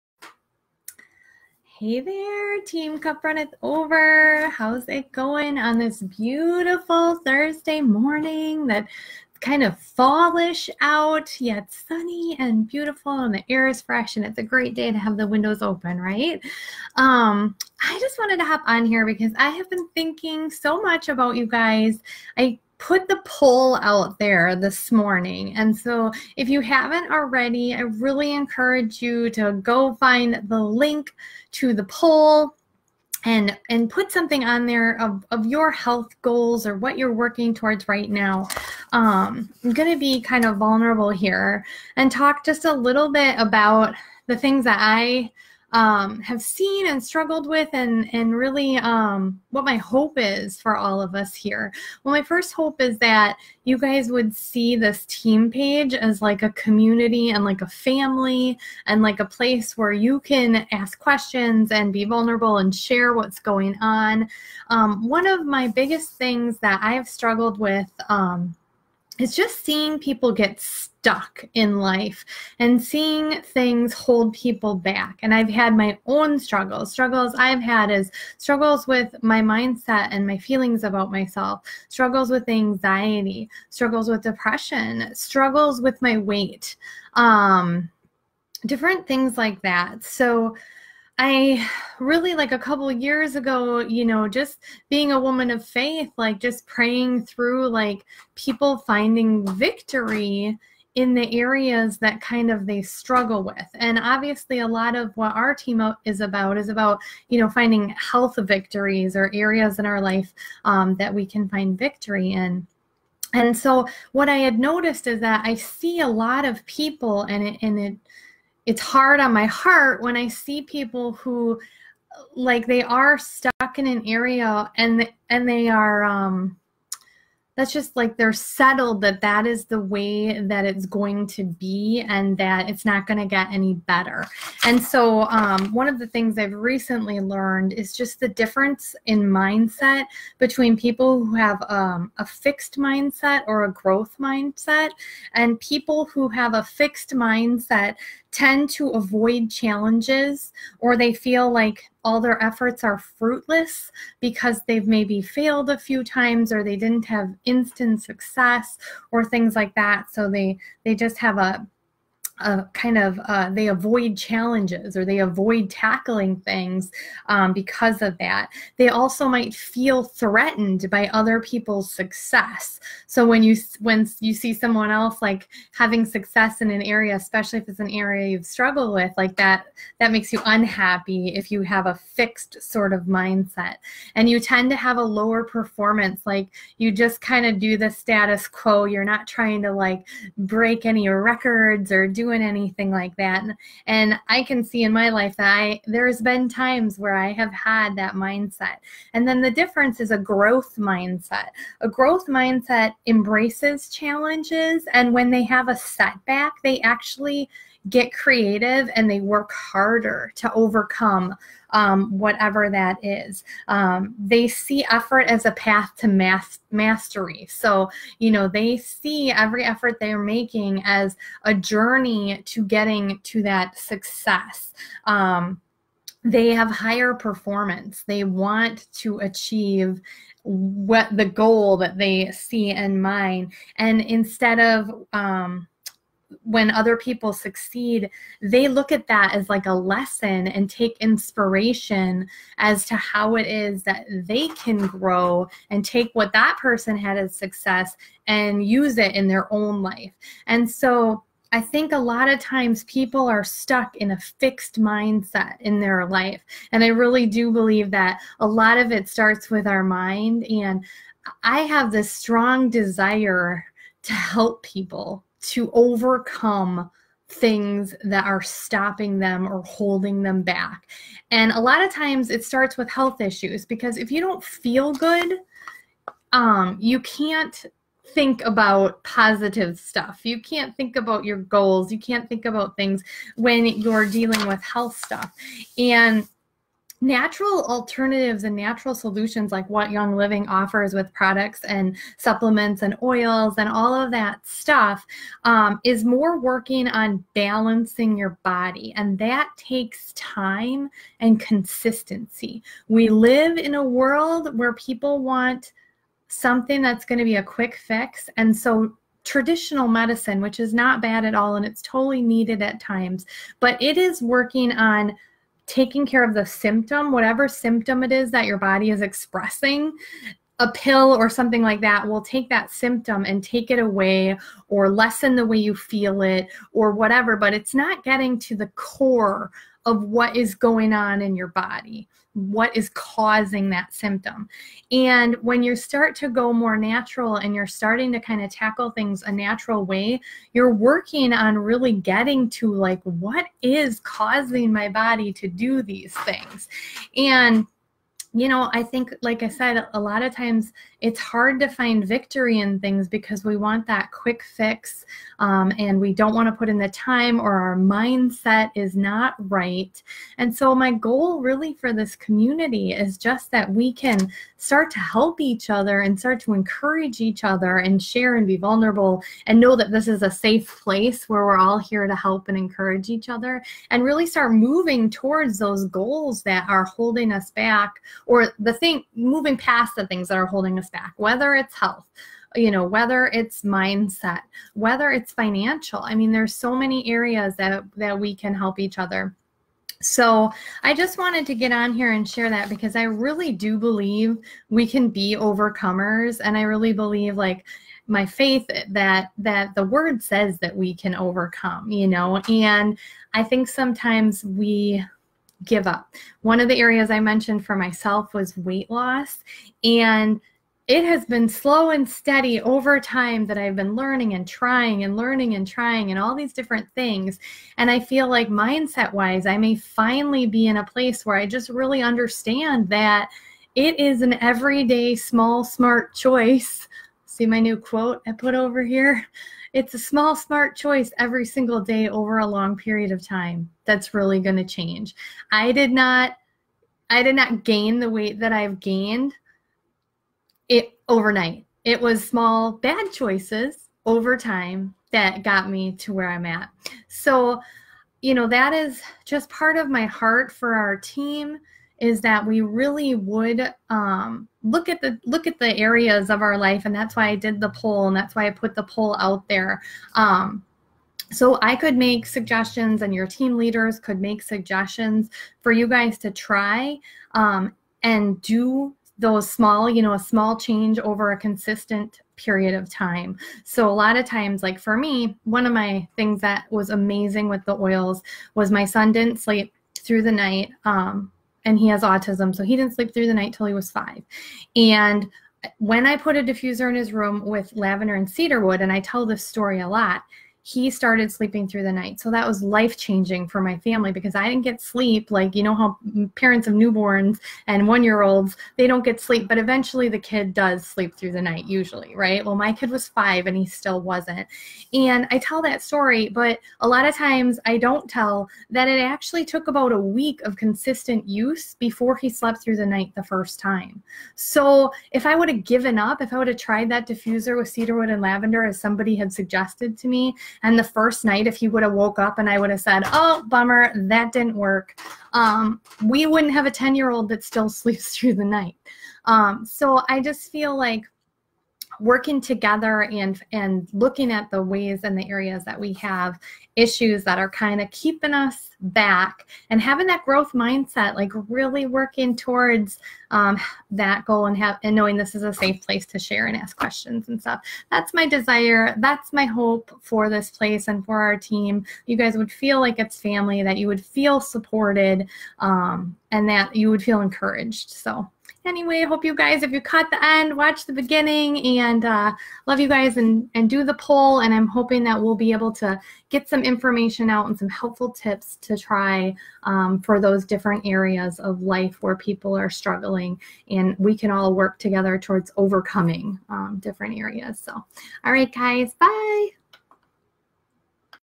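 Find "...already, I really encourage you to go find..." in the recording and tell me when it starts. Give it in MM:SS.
00:27.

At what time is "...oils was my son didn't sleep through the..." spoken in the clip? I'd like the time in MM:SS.
07:57.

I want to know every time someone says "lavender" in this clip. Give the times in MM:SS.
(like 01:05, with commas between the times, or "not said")
08:07, 08:38.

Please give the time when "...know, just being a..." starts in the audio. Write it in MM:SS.
01:34.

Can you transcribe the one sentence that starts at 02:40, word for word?
So they they just have a uh, kind of uh, they avoid challenges or they avoid tackling things um, because of that.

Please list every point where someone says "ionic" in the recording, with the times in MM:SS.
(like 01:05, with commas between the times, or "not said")
not said.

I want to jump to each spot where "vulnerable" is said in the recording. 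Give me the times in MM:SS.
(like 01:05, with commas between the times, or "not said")
00:40, 01:02, 06:08.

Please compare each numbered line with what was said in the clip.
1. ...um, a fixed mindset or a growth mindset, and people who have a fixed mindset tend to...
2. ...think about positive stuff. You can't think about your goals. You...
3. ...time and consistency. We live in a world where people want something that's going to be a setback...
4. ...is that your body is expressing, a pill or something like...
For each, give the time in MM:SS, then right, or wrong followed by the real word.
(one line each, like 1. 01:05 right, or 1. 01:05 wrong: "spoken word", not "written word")
1. 02:21 right
2. 04:38 right
3. 05:00 wrong: "quick", not "setback"
4. 05:18 right.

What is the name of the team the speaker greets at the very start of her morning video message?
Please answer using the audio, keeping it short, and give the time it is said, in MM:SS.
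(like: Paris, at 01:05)
Cup Runneth Over, at 00:02.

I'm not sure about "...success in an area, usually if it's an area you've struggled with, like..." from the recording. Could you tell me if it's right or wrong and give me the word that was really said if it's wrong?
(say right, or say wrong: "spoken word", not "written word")
wrong: "especially", not "usually".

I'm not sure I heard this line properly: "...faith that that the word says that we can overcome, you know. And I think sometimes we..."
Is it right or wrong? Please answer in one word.
right.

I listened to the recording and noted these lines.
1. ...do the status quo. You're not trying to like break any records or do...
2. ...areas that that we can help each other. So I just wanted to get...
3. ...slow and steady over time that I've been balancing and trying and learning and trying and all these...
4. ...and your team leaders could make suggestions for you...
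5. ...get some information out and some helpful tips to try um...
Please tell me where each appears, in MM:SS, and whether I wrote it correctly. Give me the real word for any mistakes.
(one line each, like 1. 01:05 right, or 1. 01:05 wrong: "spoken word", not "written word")
1. 03:07 right
2. 06:27 right
3. 06:51 wrong: "learning", not "balancing"
4. 07:43 right
5. 09:26 right.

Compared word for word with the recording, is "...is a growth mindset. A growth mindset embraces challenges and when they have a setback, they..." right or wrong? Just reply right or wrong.
right.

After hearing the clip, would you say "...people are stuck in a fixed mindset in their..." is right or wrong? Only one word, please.
right.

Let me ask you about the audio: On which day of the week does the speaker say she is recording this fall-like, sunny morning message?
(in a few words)
Thursday.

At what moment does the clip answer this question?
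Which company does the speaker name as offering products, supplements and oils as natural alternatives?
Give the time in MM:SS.
04:49.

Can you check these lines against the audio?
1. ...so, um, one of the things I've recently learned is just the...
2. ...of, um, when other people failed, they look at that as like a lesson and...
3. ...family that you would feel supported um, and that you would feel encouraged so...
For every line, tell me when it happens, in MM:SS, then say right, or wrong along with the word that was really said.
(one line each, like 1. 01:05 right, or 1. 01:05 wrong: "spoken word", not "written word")
1. 02:14 right
2. 03:54 wrong: "succeed", not "failed"
3. 09:13 right.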